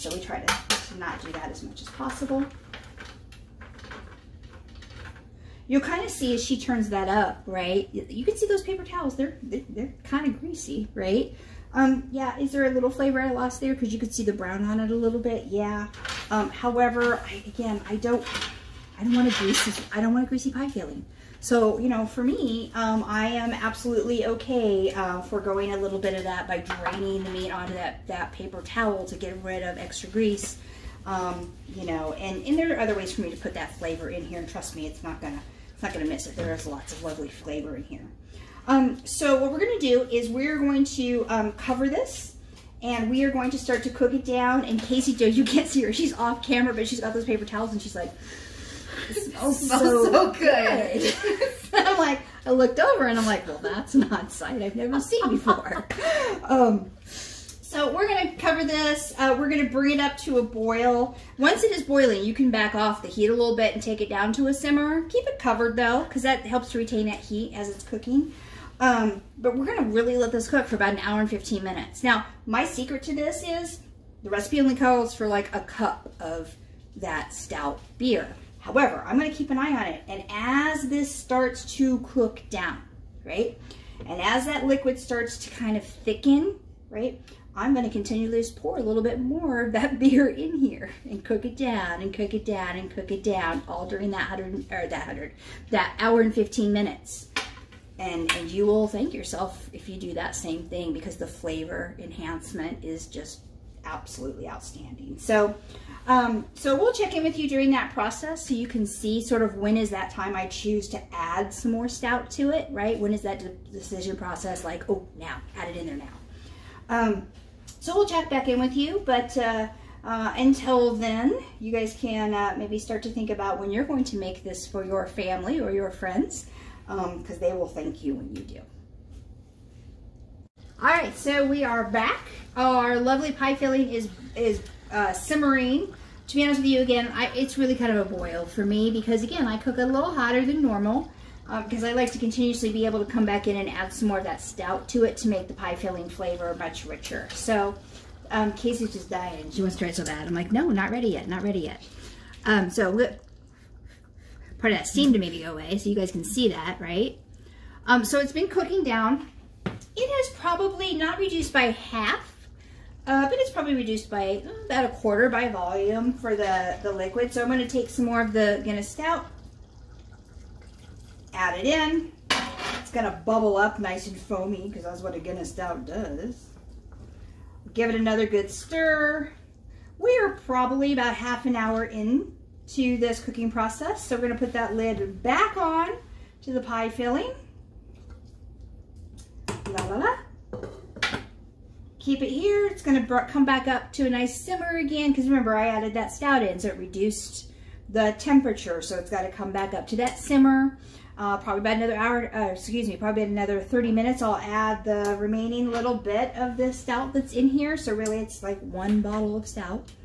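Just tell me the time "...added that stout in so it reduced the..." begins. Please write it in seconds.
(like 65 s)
195 s.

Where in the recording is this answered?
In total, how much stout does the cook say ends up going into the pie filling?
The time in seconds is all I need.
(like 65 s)
208 s.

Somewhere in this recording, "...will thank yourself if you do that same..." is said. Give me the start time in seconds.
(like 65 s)
98 s.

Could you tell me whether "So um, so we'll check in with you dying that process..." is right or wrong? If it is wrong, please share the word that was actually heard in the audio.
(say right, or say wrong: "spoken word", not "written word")
wrong: "during", not "dying".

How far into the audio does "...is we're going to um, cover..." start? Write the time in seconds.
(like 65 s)
40 s.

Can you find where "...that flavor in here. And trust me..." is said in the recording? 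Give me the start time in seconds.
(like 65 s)
33 s.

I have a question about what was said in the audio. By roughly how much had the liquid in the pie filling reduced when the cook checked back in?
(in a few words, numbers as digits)
a quarter.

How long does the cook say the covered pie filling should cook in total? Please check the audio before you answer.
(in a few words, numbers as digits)
1 hour 15 minutes.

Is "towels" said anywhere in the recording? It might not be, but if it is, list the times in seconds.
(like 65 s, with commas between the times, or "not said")
8 s, 28 s, 47 s.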